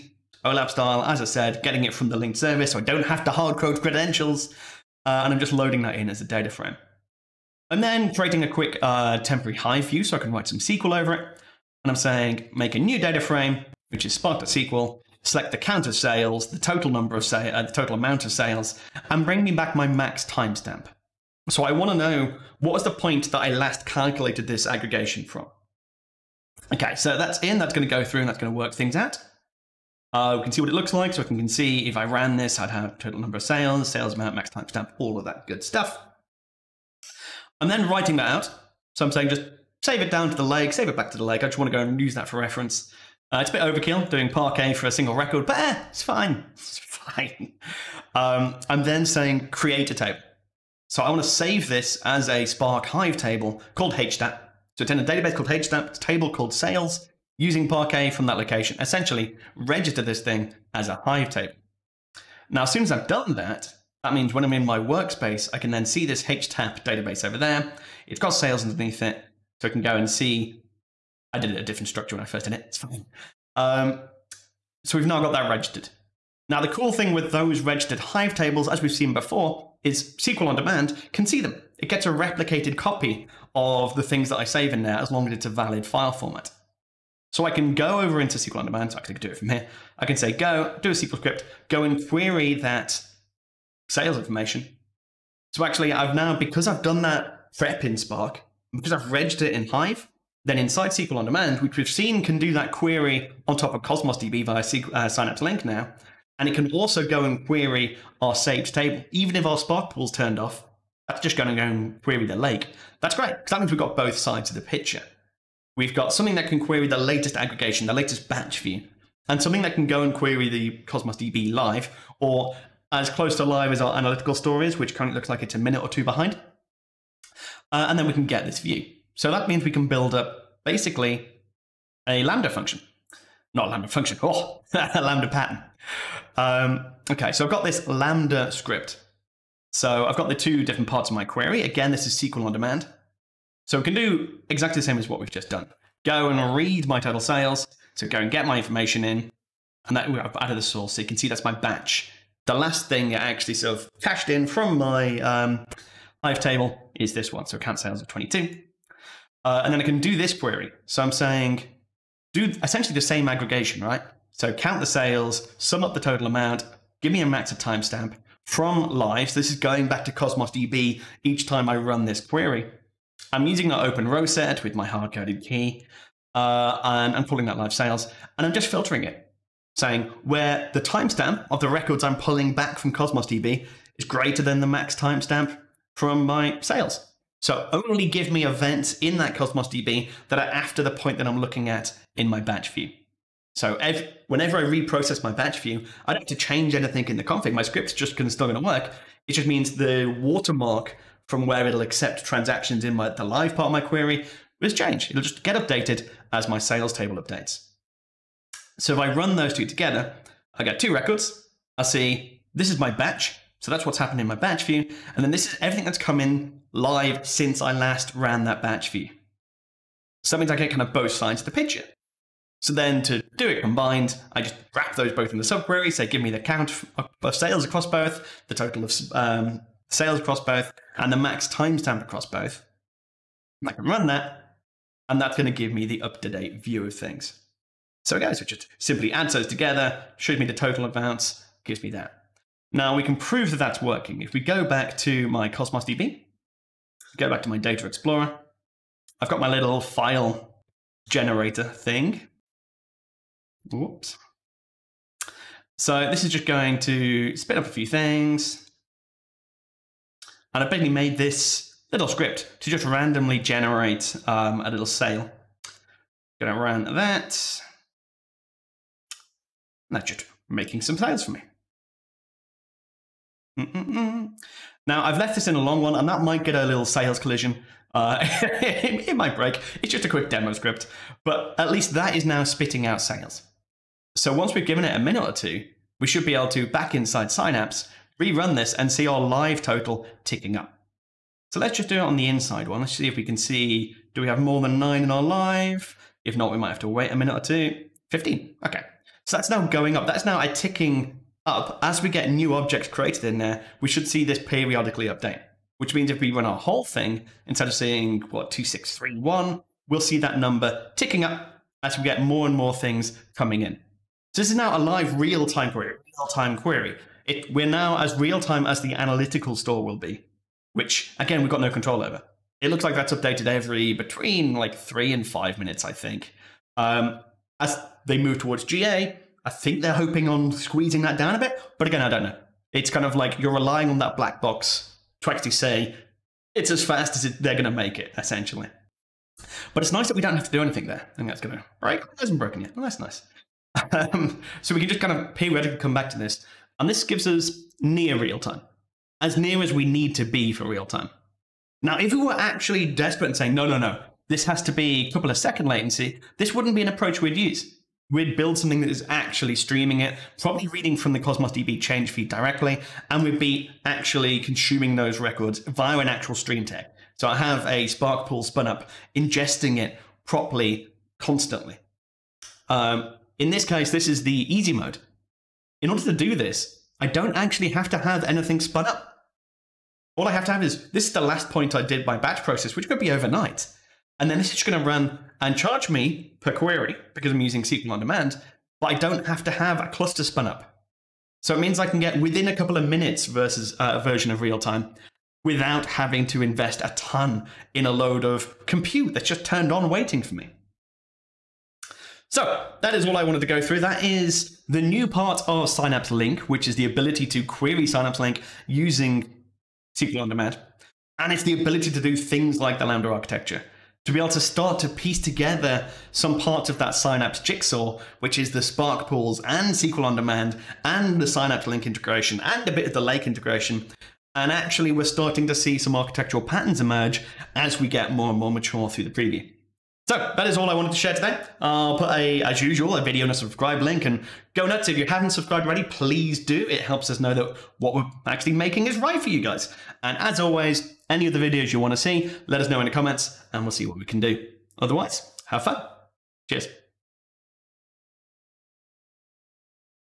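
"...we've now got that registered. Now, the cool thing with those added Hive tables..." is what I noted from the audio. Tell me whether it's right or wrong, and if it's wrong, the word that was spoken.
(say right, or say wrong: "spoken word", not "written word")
wrong: "registered", not "added".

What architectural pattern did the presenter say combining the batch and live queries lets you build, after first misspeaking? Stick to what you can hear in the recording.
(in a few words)
Lambda pattern.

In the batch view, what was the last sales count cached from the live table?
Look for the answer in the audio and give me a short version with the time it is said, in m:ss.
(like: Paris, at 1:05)
22, at 2:38.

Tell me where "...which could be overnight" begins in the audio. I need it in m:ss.
6:22.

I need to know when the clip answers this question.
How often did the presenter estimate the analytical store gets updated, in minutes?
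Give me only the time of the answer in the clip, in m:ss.
5:24.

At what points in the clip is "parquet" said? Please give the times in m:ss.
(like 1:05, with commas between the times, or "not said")
0:44, 0:57.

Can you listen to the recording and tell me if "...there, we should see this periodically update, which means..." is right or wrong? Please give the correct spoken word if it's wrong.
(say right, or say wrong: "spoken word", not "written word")
right.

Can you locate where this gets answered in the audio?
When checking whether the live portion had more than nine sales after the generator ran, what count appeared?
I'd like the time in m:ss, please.
4:58.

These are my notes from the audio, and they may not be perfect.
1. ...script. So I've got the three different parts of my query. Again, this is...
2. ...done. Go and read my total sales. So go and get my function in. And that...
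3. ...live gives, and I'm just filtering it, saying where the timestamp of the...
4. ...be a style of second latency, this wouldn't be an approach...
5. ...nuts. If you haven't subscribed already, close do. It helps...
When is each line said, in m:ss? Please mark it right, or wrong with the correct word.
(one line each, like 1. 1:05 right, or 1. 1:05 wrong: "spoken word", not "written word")
1. 2:18 wrong: "two", not "three"
2. 2:25 wrong: "information", not "function"
3. 2:57 wrong: "sales", not "gives"
4. 5:54 wrong: "couple", not "style"
5. 7:14 wrong: "please", not "close".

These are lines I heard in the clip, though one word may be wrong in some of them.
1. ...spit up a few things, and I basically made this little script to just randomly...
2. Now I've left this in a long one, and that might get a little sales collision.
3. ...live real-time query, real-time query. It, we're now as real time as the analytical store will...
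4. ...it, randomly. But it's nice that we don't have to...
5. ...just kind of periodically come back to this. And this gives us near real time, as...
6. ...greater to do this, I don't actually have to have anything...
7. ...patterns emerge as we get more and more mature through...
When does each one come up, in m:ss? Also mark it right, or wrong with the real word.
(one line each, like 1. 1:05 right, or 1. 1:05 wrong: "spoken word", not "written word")
1. 4:17 right
2. 4:34 right
3. 5:14 right
4. 5:37 wrong: "essentially", not "randomly"
5. 5:44 right
6. 6:15 wrong: "order", not "greater"
7. 7:06 right.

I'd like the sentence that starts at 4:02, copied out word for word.
Now we can prove that that's working.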